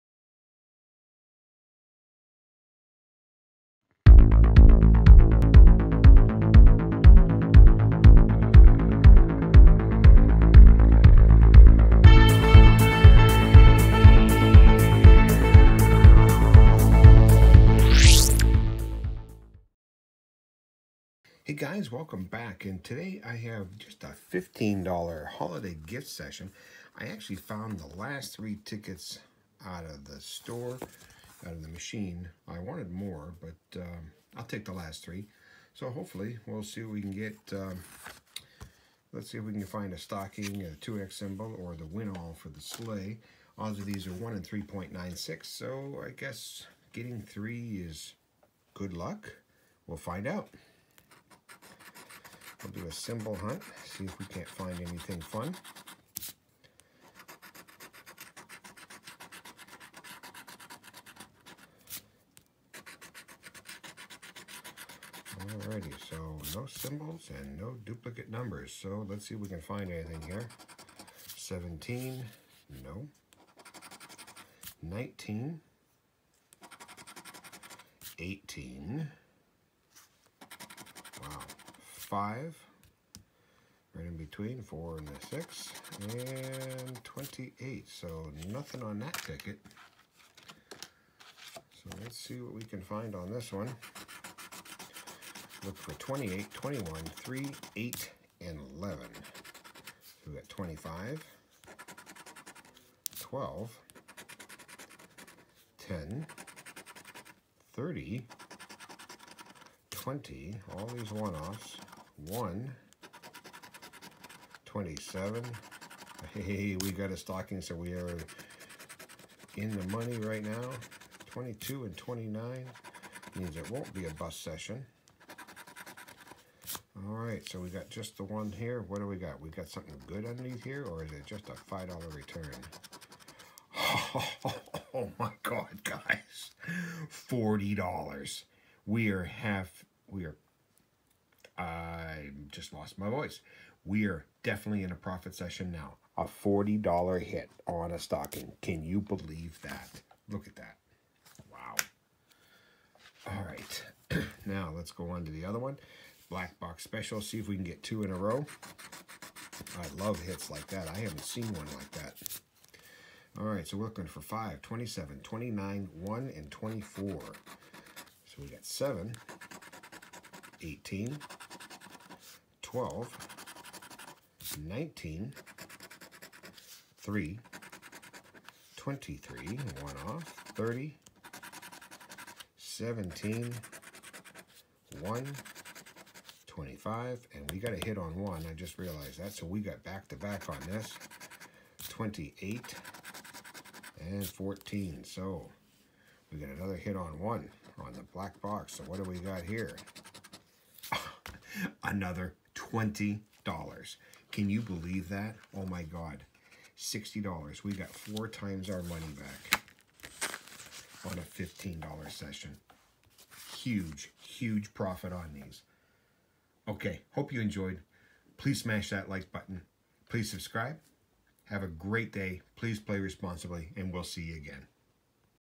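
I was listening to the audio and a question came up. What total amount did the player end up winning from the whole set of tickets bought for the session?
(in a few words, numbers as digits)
$60.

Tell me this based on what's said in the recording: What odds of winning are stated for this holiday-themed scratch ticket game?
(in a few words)
3.96.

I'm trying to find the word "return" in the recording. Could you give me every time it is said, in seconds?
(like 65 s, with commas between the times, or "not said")
132 s.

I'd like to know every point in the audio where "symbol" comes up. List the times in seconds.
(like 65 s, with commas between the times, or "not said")
41 s, 52 s, 66 s.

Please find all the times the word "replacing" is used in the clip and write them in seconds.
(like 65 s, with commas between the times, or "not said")
not said.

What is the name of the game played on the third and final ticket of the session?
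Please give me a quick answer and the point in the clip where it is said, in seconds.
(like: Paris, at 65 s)
Black Box Special, at 156 s.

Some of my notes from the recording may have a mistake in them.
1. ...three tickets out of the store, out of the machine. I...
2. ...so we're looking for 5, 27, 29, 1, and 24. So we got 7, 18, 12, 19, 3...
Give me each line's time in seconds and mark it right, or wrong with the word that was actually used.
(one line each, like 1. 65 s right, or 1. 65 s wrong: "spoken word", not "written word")
1. 28 s right
2. 163 s right.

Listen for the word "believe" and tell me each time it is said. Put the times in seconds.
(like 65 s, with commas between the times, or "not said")
149 s, 204 s.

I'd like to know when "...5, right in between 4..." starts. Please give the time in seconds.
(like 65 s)
82 s.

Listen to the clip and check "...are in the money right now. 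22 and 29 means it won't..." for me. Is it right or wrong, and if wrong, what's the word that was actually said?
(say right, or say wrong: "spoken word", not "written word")
right.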